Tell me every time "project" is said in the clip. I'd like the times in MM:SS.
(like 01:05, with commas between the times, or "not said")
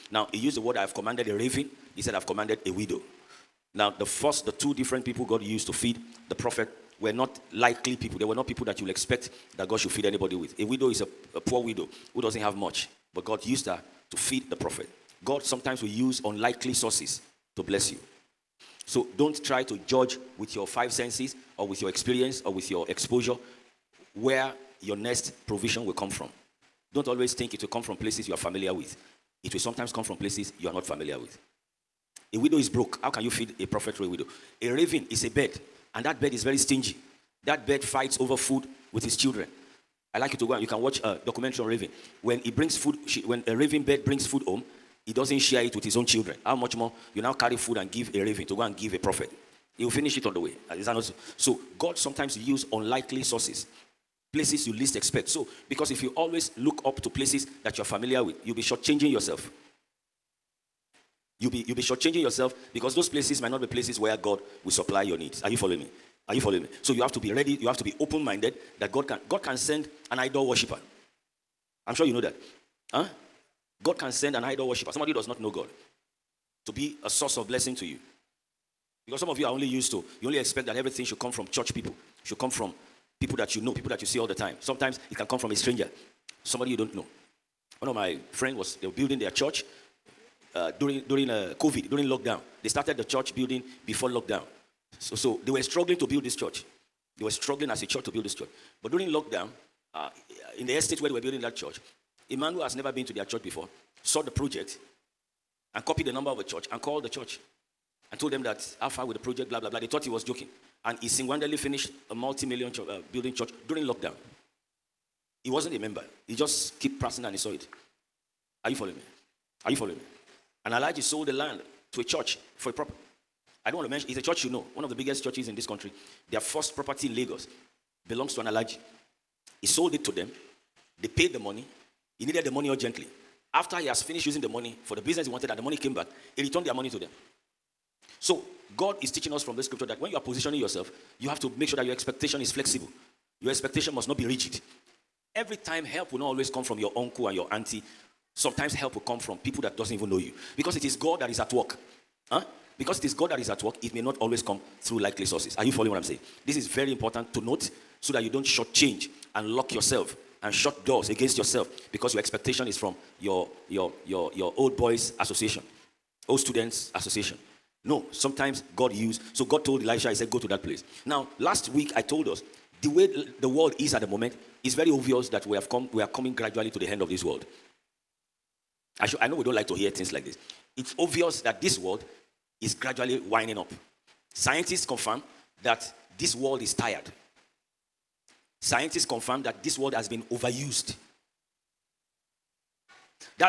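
01:44, 01:49.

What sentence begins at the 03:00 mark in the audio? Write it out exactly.
It's obvious that this world is gradually winding up.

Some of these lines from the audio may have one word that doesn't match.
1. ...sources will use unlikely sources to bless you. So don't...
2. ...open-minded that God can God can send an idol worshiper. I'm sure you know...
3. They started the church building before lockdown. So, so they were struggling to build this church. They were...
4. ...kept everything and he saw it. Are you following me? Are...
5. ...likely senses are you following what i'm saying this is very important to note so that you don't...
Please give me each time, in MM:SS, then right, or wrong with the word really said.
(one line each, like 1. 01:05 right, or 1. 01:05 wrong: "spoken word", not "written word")
1. 00:15 wrong: "sometimes", not "sources"
2. 01:07 right
3. 01:32 right
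4. 01:56 wrong: "pressing", not "everything"
5. 02:34 wrong: "sources", not "senses".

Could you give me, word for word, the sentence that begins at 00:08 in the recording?
They were not people that you'll expect that God should feed anybody with.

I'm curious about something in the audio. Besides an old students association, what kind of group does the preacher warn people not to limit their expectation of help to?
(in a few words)
Old boys association.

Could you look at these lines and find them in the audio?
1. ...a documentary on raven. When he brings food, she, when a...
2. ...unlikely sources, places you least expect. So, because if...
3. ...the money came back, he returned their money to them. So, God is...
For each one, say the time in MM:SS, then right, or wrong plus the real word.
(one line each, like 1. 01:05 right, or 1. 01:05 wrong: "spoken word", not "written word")
1. 00:41 right
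2. 00:52 right
3. 02:15 right.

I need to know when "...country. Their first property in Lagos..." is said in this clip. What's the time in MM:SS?
02:05.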